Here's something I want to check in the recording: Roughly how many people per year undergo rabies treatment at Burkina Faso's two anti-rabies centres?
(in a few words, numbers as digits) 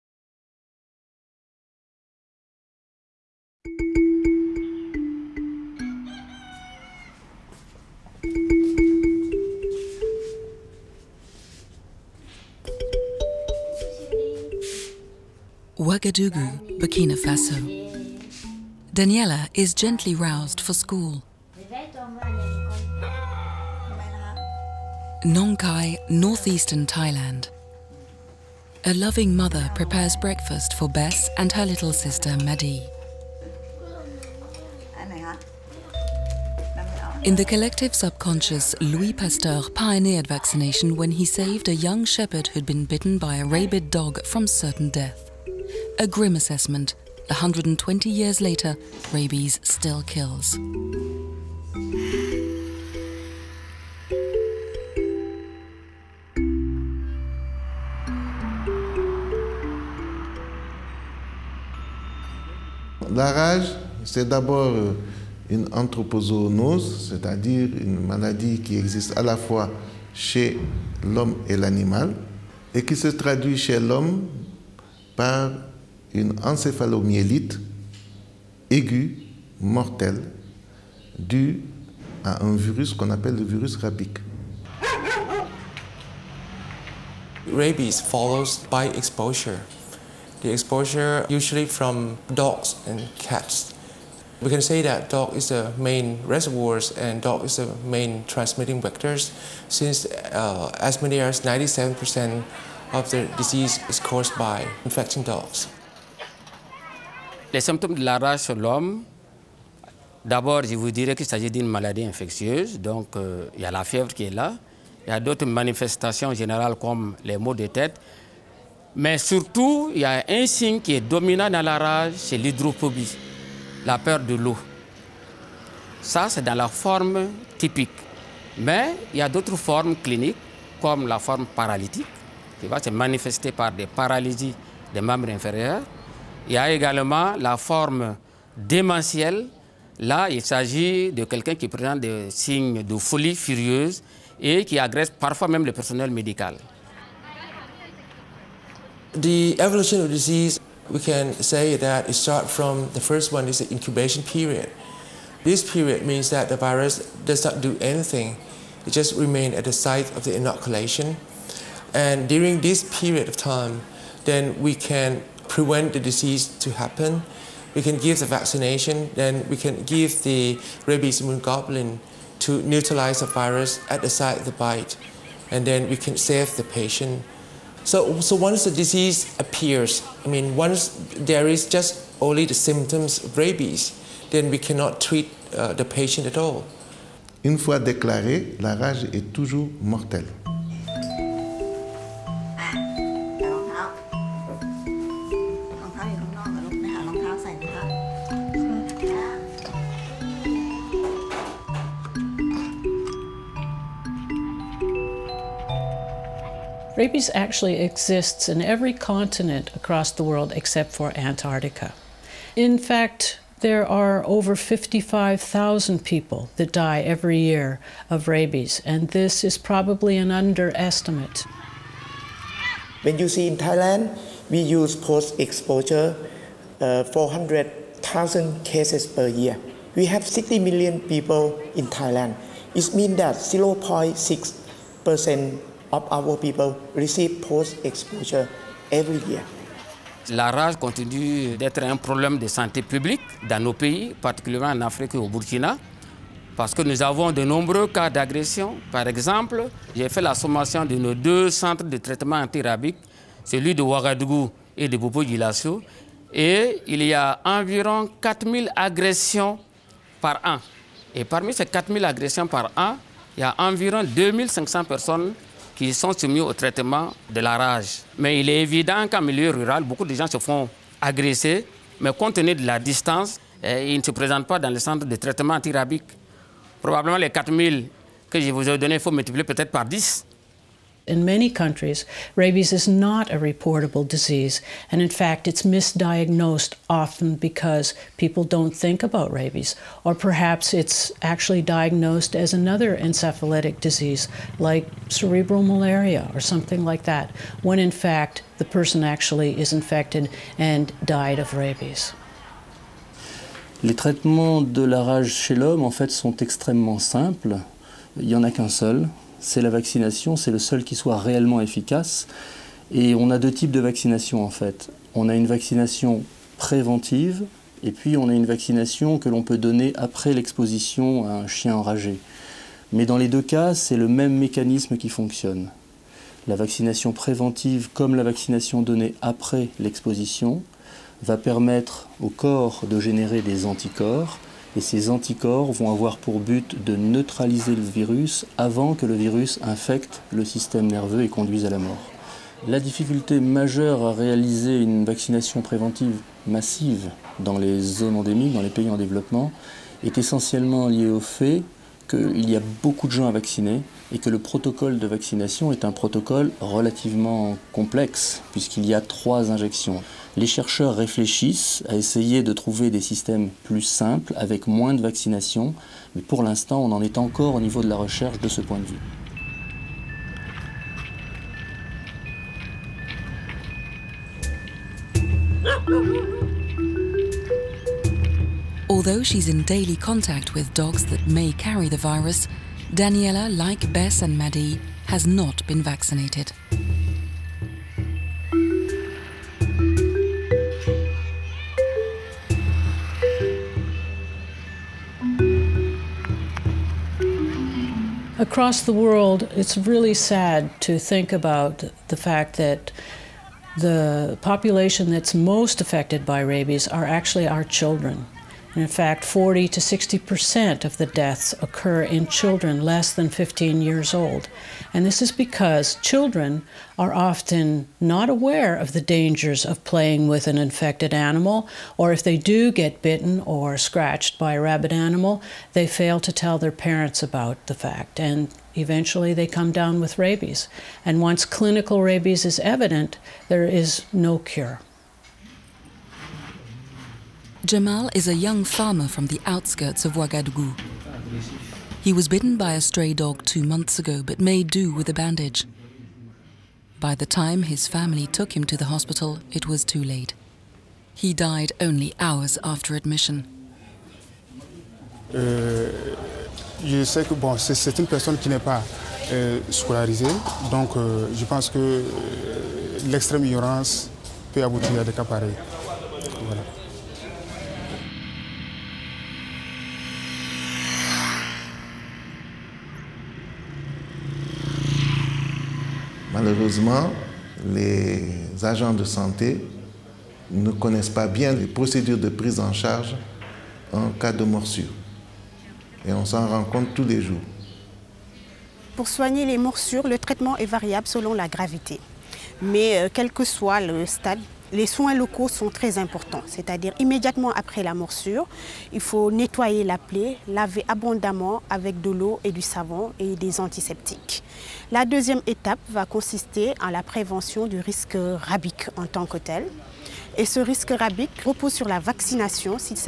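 2500.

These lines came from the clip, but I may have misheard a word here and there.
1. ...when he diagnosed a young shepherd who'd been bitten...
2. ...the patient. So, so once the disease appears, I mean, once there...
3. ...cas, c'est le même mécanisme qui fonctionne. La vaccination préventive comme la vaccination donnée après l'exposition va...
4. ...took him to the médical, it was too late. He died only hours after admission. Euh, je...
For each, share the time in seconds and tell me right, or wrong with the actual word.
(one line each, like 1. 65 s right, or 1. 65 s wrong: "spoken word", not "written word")
1. 40 s wrong: "saved", not "diagnosed"
2. 176 s right
3. 323 s right
4. 448 s wrong: "hospital", not "médical".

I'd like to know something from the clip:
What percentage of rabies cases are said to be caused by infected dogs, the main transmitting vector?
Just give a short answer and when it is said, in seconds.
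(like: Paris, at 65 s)
97%, at 101 s.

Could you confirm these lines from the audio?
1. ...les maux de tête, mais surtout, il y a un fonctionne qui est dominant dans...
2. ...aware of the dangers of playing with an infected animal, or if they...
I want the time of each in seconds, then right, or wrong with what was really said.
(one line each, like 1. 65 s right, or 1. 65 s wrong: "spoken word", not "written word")
1. 117 s wrong: "signe", not "fonctionne"
2. 418 s right.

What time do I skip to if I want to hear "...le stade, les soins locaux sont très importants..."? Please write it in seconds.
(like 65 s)
493 s.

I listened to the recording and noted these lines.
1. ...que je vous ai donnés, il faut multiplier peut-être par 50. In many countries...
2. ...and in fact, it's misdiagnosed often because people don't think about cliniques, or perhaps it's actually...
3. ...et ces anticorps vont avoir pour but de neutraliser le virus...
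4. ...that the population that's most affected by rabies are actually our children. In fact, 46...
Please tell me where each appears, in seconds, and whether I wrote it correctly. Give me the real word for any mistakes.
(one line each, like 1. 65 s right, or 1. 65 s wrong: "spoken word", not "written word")
1. 278 s wrong: "10", not "50"
2. 284 s wrong: "rabies", not "cliniques"
3. 334 s right
4. 402 s wrong: "40", not "46".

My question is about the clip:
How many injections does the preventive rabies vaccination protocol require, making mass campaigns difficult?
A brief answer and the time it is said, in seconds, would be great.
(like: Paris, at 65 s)
3, at 358 s.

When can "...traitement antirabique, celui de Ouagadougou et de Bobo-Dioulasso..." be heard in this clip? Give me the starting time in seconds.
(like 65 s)
251 s.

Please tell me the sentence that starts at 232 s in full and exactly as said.
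It means that 0.6% our people receive post-exposure every year.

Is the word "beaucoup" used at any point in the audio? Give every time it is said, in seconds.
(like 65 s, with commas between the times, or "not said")
269 s, 352 s.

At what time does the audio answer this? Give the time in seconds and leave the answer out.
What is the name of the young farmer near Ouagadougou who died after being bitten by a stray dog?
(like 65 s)
437 s.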